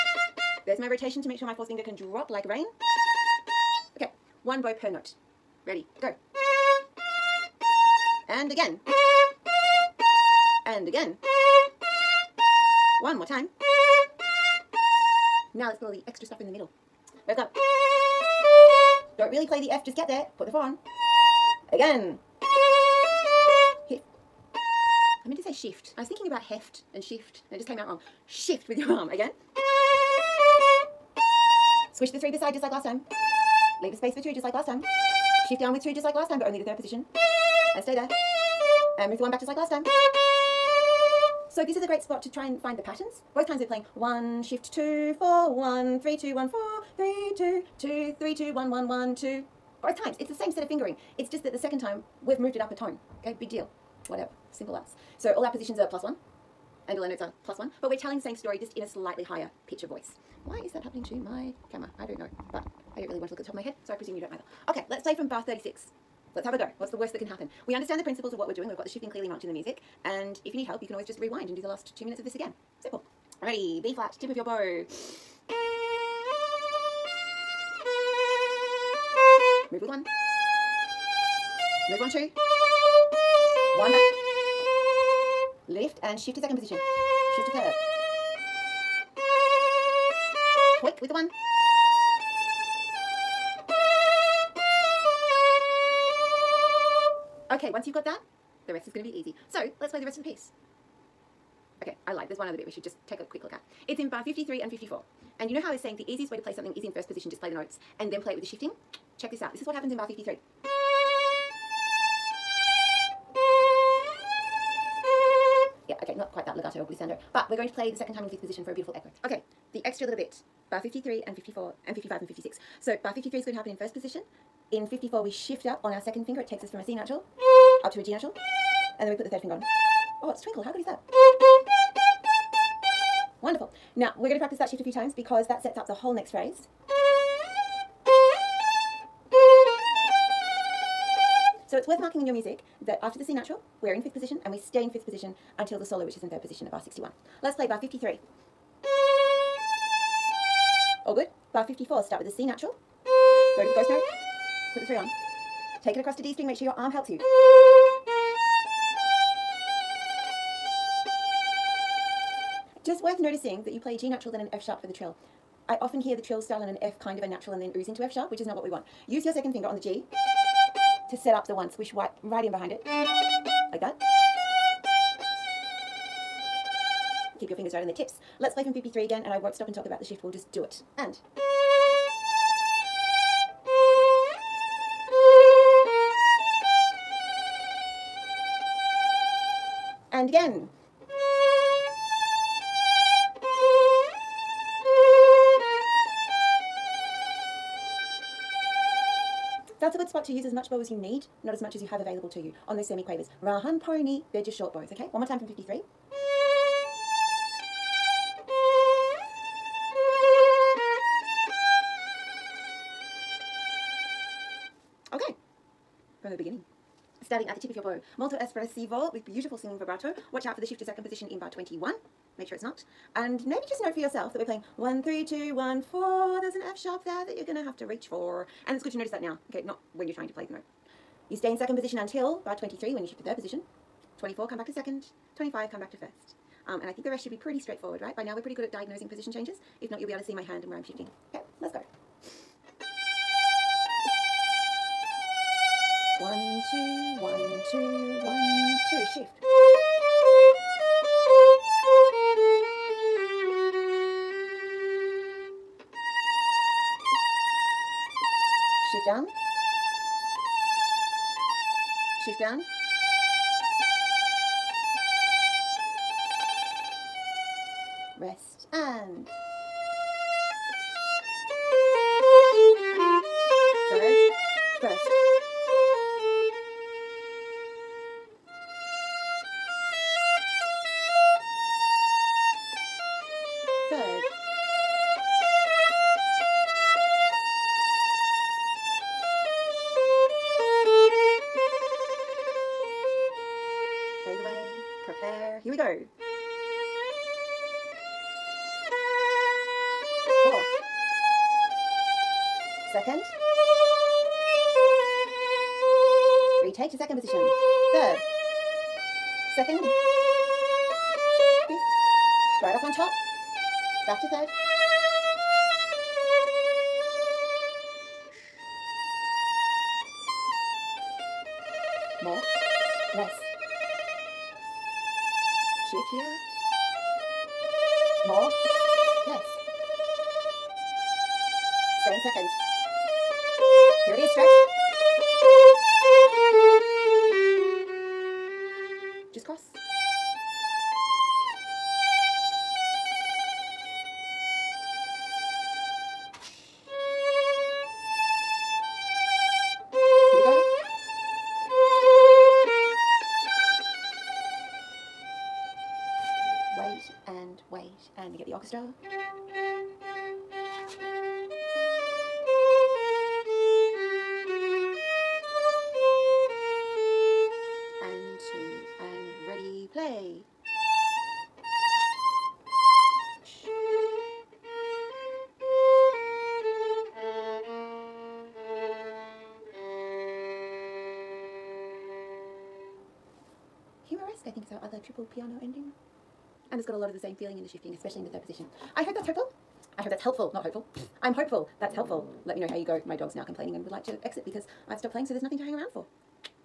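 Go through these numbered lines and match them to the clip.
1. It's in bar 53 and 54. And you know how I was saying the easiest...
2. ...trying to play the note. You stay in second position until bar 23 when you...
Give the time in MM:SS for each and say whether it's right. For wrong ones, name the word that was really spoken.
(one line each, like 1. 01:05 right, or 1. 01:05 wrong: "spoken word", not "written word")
1. 01:43 right
2. 03:50 right.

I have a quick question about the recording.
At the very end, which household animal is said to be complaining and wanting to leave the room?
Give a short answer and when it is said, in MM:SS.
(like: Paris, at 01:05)
Dog, at 06:33.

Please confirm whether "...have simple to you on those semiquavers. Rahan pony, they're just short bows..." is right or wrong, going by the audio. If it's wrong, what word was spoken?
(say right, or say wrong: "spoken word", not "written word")
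wrong: "available", not "simple".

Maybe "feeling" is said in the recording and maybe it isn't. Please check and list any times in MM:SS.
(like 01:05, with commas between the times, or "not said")
06:27.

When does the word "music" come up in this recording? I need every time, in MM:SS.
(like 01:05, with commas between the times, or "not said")
01:09, 02:22.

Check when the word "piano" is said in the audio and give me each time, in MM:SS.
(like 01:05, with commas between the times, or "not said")
06:25.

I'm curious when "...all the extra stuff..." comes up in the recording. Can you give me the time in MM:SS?
00:15.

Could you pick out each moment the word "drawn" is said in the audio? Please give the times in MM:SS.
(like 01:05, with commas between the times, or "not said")
not said.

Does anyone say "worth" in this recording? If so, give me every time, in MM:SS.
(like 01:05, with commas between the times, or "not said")
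02:21, 02:43.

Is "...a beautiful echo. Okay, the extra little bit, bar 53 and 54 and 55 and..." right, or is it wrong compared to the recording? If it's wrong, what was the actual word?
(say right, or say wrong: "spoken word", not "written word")
right.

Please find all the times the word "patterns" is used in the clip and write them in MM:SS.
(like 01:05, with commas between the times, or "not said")
00:42.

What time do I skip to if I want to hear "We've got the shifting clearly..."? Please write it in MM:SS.
01:08.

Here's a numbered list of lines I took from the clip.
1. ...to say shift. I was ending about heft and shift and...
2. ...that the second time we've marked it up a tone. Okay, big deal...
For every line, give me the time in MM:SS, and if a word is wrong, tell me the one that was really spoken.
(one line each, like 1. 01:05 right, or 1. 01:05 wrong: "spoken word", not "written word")
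1. 00:25 wrong: "thinking", not "ending"
2. 00:51 wrong: "moved", not "marked".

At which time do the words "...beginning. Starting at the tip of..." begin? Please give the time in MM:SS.
03:36.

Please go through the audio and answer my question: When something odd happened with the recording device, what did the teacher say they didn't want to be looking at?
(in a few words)
The top of my head.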